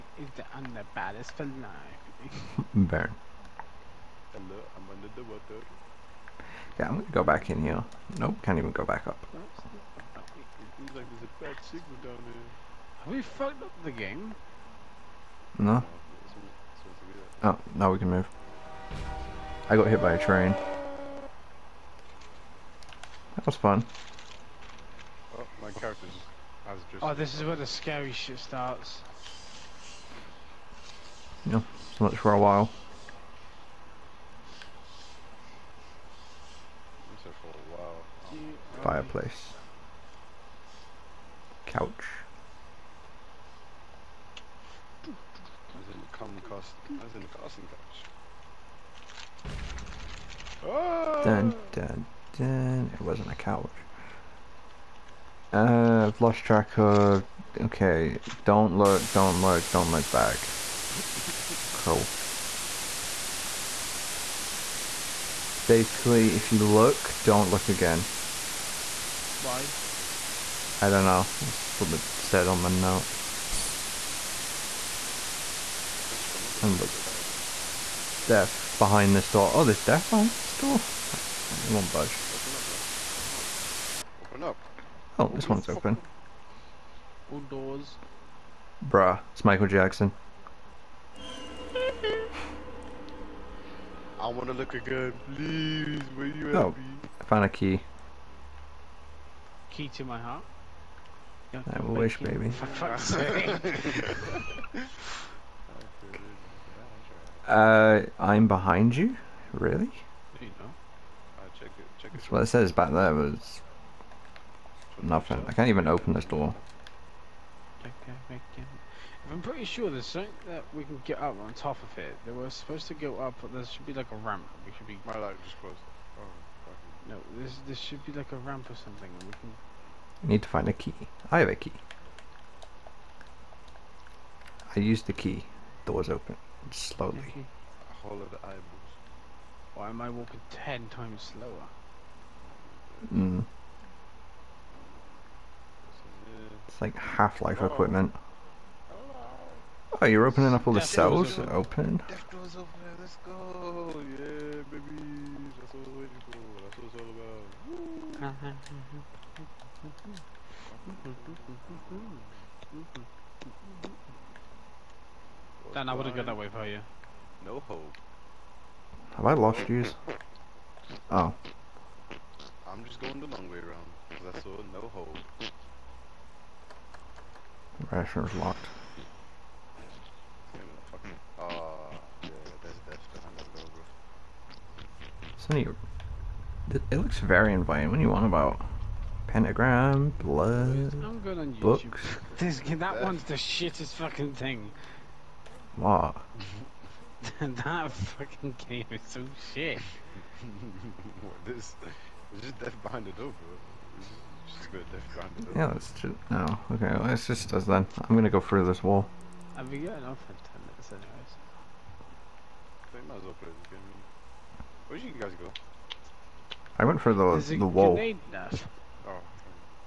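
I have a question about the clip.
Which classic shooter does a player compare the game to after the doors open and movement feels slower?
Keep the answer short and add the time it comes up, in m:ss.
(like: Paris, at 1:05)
Half-Life, at 2:26.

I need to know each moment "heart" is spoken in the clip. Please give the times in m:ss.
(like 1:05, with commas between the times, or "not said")
1:40.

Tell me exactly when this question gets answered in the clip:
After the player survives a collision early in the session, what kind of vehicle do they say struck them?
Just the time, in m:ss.
0:20.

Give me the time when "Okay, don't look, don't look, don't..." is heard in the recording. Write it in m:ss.
0:57.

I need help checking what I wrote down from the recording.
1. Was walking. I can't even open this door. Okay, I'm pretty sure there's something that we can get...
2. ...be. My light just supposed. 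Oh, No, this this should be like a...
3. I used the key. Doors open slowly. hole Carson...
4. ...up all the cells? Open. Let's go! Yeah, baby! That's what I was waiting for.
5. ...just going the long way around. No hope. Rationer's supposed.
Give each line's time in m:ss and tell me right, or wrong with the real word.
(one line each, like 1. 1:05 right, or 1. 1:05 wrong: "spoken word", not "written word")
1. 1:53 wrong: "nothing", not "walking"
2. 2:04 wrong: "closed", not "supposed"
3. 2:14 wrong: "Hollow", not "Carson"
4. 2:30 right
5. 2:52 wrong: "locked", not "supposed".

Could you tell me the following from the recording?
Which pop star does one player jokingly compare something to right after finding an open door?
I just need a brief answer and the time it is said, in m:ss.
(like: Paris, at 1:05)
Michael Jackson, at 1:29.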